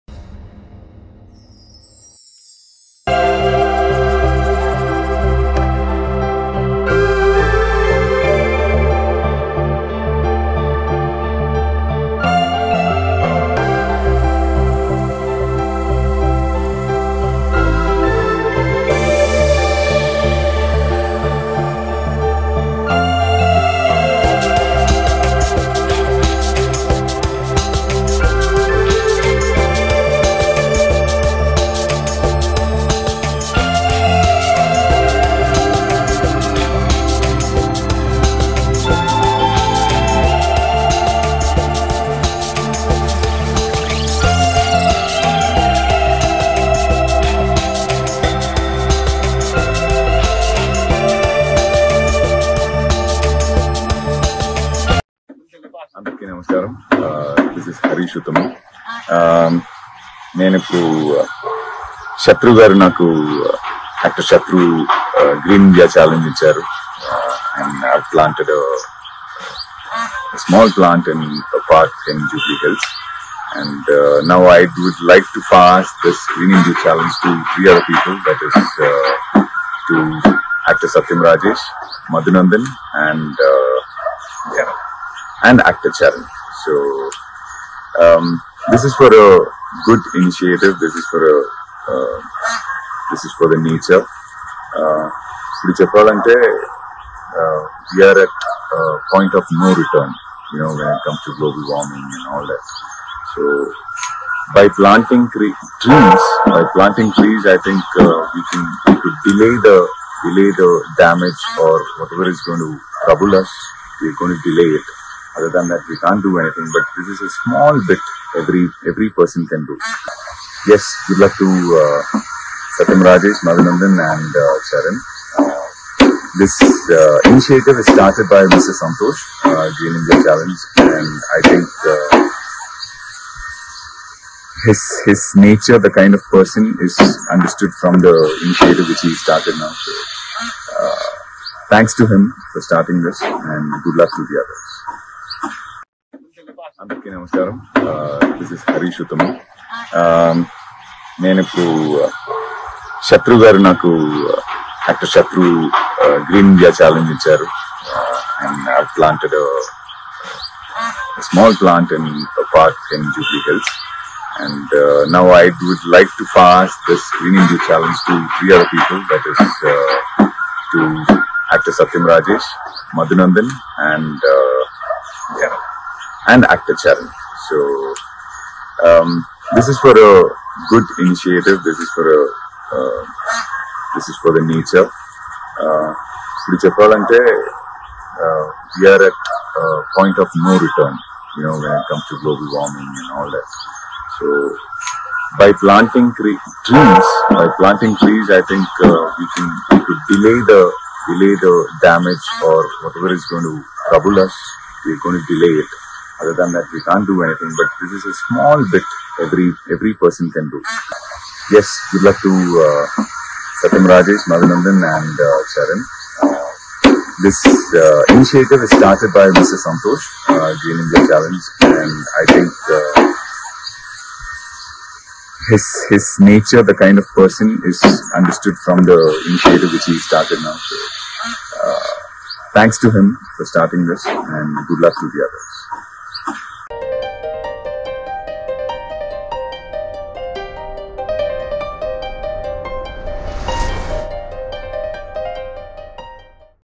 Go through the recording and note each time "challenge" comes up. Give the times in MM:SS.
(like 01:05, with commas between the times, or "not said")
01:16, 02:10, 03:41.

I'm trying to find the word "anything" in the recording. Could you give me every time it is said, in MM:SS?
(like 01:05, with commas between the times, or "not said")
01:56, 03:27.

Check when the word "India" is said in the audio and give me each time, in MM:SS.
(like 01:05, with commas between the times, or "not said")
01:16, 02:09.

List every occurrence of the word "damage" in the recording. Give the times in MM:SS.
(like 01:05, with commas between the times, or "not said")
01:51, 03:21.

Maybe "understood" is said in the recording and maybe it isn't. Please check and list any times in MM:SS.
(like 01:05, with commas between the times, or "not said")
02:17, 03:48.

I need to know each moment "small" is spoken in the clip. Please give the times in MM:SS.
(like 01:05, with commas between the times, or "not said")
01:57, 03:28.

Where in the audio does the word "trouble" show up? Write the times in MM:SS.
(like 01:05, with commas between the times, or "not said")
01:53, 03:23.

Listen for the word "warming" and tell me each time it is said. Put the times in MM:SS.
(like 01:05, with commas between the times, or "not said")
01:41, 03:12.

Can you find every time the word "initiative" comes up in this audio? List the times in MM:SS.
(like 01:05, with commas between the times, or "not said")
01:30, 02:07, 02:18, 03:01, 03:38, 03:49.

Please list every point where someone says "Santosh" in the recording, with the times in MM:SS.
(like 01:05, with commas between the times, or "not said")
02:08, 03:39.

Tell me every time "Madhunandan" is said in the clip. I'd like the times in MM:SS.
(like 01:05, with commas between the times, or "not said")
01:22, 02:03, 03:34.